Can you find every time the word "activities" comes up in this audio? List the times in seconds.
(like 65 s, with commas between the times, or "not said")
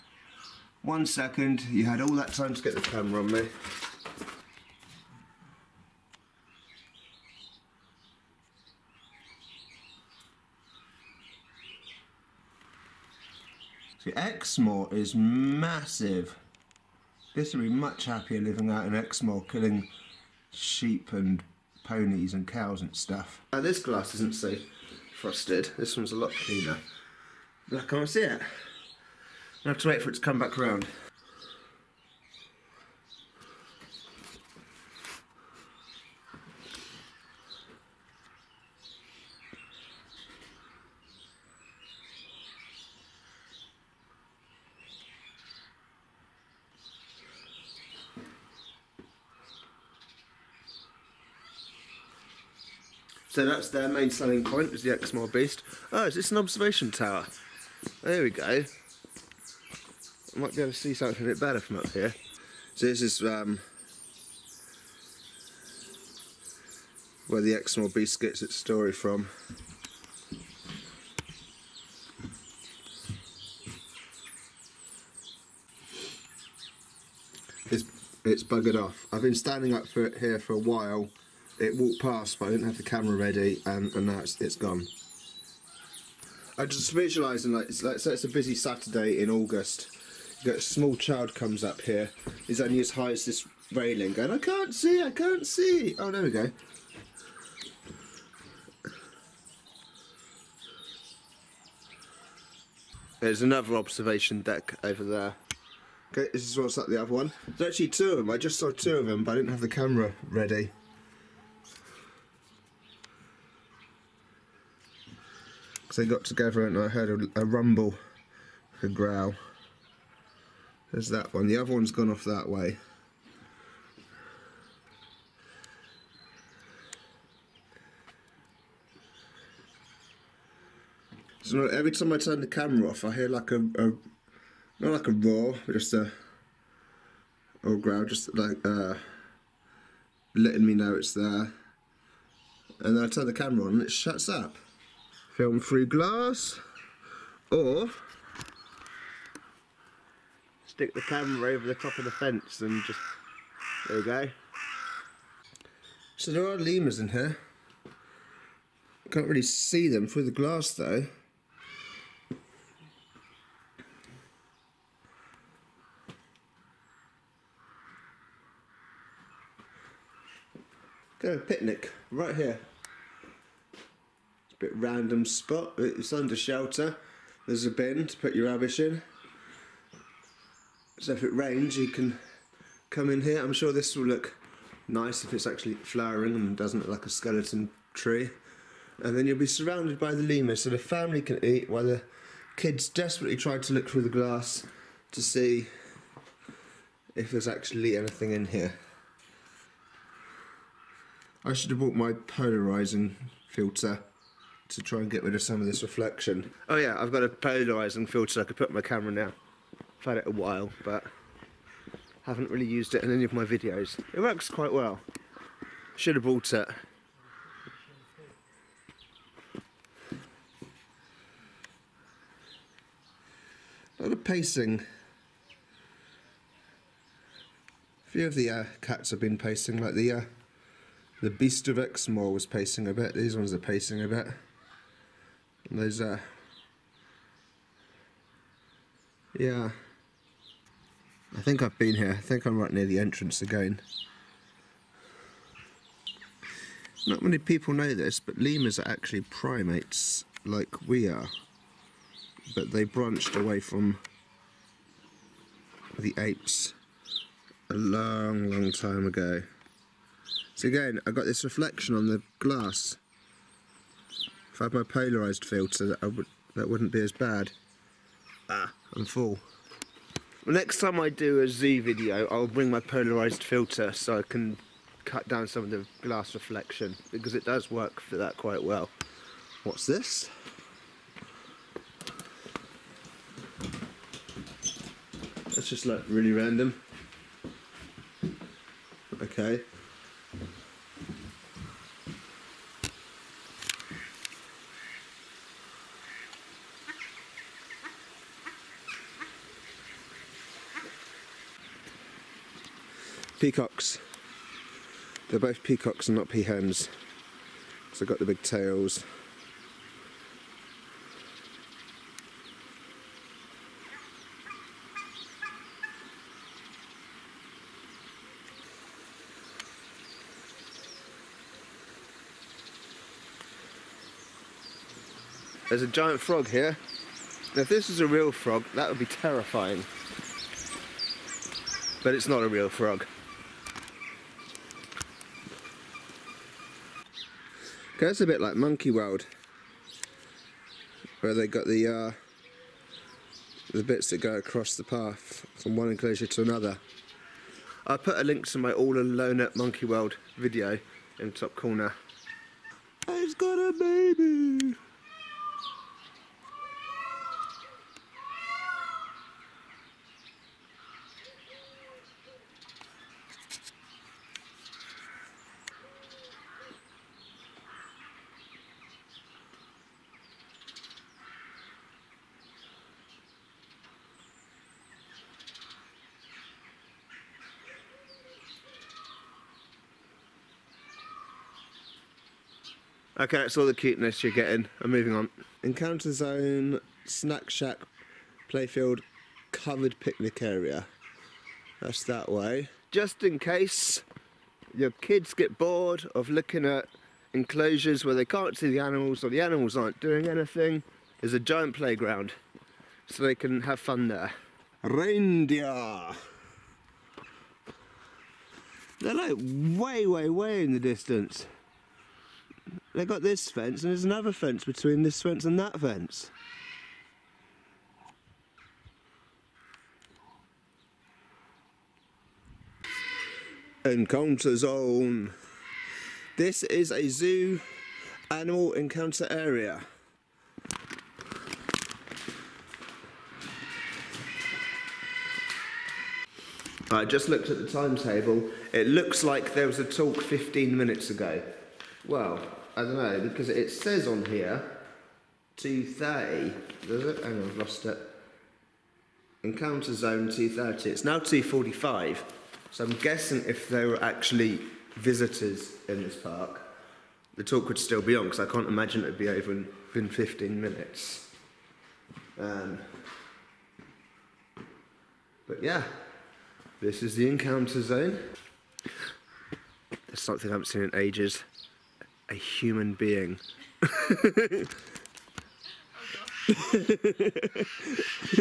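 not said.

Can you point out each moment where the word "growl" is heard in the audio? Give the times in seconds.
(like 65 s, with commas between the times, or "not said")
118 s, 137 s.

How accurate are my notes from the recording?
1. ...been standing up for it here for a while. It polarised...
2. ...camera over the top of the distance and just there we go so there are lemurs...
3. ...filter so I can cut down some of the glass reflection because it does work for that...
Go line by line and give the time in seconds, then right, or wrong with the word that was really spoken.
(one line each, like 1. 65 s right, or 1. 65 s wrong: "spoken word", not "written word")
1. 79 s wrong: "walked", not "polarised"
2. 151 s wrong: "fence", not "distance"
3. 273 s right.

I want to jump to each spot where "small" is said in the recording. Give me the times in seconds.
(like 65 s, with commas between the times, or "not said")
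90 s.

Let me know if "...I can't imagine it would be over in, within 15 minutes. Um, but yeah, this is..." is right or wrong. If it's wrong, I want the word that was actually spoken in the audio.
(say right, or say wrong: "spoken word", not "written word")
right.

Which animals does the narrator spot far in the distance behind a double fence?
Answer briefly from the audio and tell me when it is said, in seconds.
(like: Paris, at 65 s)
Reindeer, at 404 s.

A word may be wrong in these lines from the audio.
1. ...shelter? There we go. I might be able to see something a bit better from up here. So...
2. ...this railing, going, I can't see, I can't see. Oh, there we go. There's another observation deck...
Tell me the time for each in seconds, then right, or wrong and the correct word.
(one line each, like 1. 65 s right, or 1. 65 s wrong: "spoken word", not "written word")
1. 56 s wrong: "tower", not "shelter"
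2. 93 s right.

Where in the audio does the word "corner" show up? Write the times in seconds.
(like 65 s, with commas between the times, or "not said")
351 s.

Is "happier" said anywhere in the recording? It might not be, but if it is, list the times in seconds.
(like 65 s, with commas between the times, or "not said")
18 s.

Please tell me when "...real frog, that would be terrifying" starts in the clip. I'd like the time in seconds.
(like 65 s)
328 s.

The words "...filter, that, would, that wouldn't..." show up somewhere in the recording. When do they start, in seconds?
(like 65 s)
265 s.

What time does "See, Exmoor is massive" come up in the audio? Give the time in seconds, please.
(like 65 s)
14 s.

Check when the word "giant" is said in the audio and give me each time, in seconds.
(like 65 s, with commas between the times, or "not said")
325 s, 401 s.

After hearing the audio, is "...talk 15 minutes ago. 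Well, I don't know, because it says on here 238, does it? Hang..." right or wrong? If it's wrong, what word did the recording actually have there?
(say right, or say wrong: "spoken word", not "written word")
wrong: "230", not "238".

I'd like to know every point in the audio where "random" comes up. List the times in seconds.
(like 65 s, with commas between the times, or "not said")
174 s, 286 s.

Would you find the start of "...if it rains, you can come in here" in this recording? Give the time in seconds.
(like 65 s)
181 s.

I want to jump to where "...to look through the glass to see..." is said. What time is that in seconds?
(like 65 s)
193 s.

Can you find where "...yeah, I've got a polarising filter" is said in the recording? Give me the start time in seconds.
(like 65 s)
206 s.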